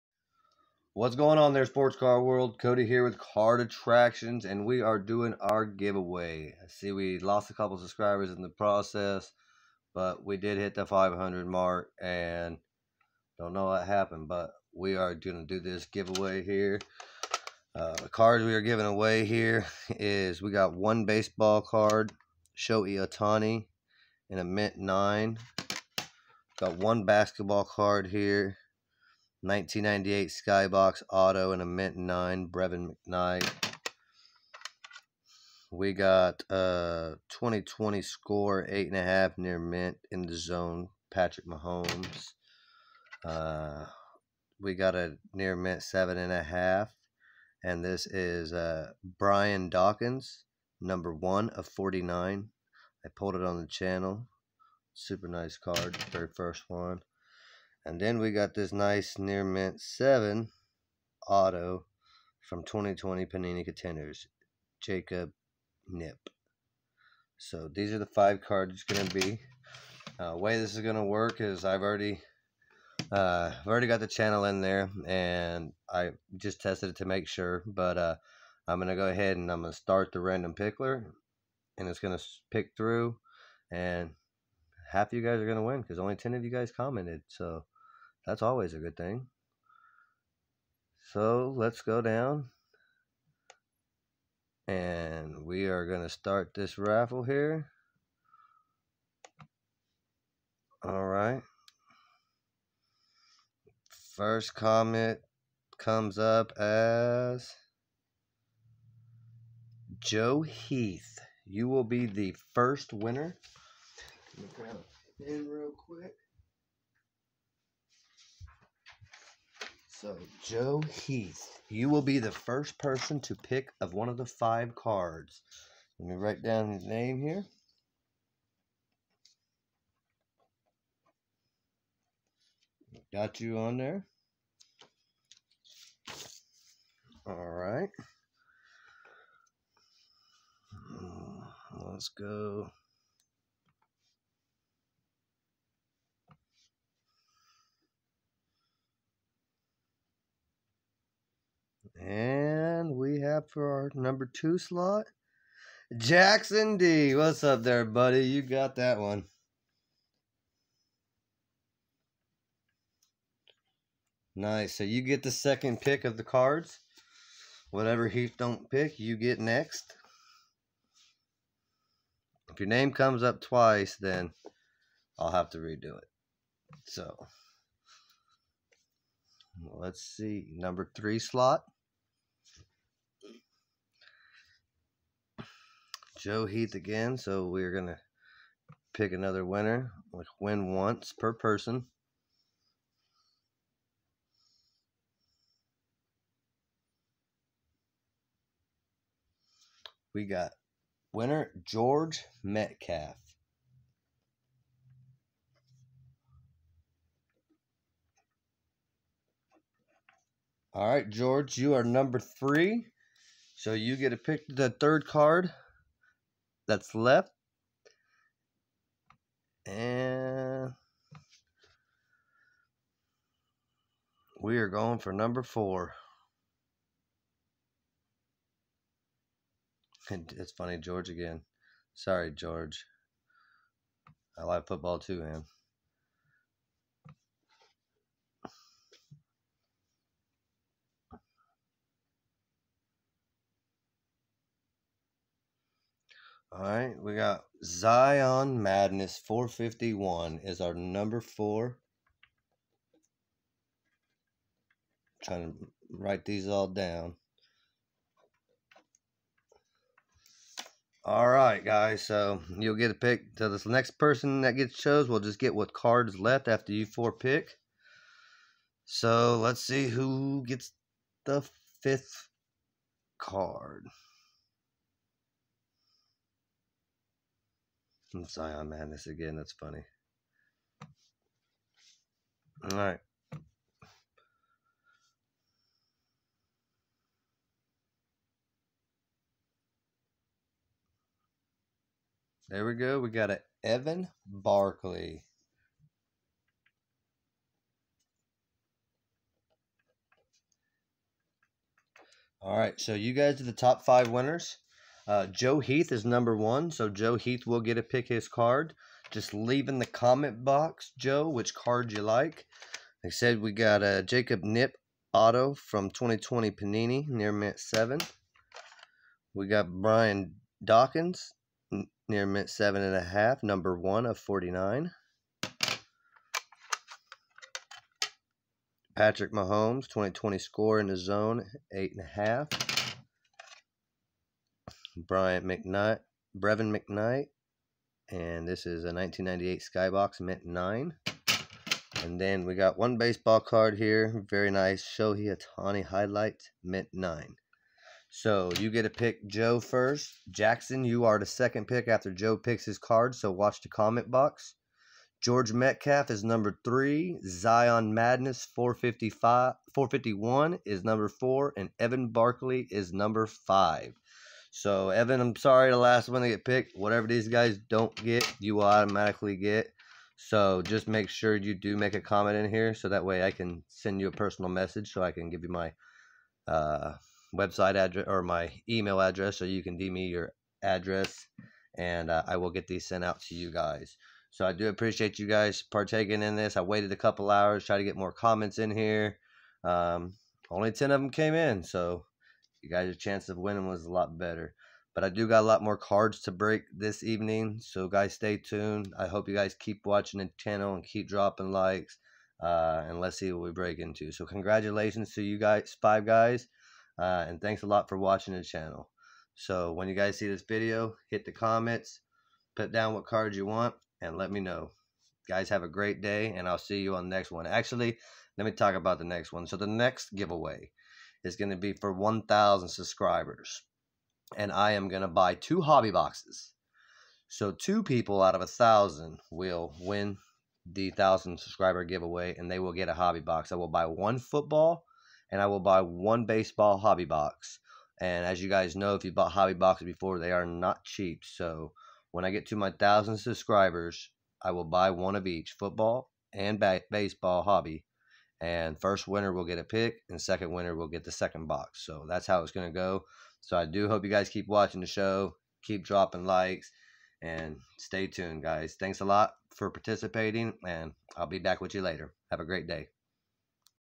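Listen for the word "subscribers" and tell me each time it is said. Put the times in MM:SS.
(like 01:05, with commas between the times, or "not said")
00:07, 07:02, 07:11, 07:23.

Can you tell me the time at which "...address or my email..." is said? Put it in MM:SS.
06:17.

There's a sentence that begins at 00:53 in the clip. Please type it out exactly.
I pulled it on the channel.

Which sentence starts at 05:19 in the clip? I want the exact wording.
We got Brian Dawkins, near mint 7.5, number 1 of 49.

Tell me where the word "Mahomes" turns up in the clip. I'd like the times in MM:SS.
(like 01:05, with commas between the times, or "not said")
00:41, 05:29.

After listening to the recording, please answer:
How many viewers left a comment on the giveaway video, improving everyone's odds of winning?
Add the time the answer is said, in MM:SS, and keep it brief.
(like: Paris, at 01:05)
10, at 01:25.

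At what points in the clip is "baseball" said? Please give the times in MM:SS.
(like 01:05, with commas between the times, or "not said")
00:21, 05:42, 07:16, 07:26.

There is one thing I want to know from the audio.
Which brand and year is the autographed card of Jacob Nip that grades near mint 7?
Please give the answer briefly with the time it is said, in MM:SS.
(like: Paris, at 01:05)
2020 Panini Contenders, at 01:02.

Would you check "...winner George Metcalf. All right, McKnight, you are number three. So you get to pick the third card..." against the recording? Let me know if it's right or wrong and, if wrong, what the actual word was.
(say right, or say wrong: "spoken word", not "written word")
wrong: "George", not "McKnight".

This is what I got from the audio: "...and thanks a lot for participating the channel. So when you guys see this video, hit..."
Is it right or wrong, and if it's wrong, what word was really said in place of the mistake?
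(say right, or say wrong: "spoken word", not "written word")
wrong: "watching", not "participating".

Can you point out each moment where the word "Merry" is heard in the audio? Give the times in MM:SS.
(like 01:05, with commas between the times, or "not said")
not said.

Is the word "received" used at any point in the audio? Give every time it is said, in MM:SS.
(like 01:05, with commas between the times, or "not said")
not said.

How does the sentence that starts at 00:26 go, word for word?
Got one basketball card here 1998 Skybox Auto and a Mint 9 Brevin McKnight.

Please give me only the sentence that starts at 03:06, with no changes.
Joe Heath again, so we're going to pick another winner.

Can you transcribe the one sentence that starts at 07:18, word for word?
And as you guys know, if you bought hobby boxes before, they are not cheap.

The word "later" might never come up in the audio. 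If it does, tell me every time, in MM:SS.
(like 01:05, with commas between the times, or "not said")
07:41.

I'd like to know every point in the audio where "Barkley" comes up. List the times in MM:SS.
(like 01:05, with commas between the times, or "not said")
04:54, 06:02.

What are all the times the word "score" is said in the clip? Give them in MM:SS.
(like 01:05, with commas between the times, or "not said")
00:38, 05:30.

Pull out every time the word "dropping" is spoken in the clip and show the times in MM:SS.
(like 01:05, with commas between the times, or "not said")
06:41, 07:35.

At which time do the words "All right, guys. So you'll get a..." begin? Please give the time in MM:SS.
04:21.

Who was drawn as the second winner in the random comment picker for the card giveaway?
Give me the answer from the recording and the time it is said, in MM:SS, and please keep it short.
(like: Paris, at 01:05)
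Jackson D, at 02:35.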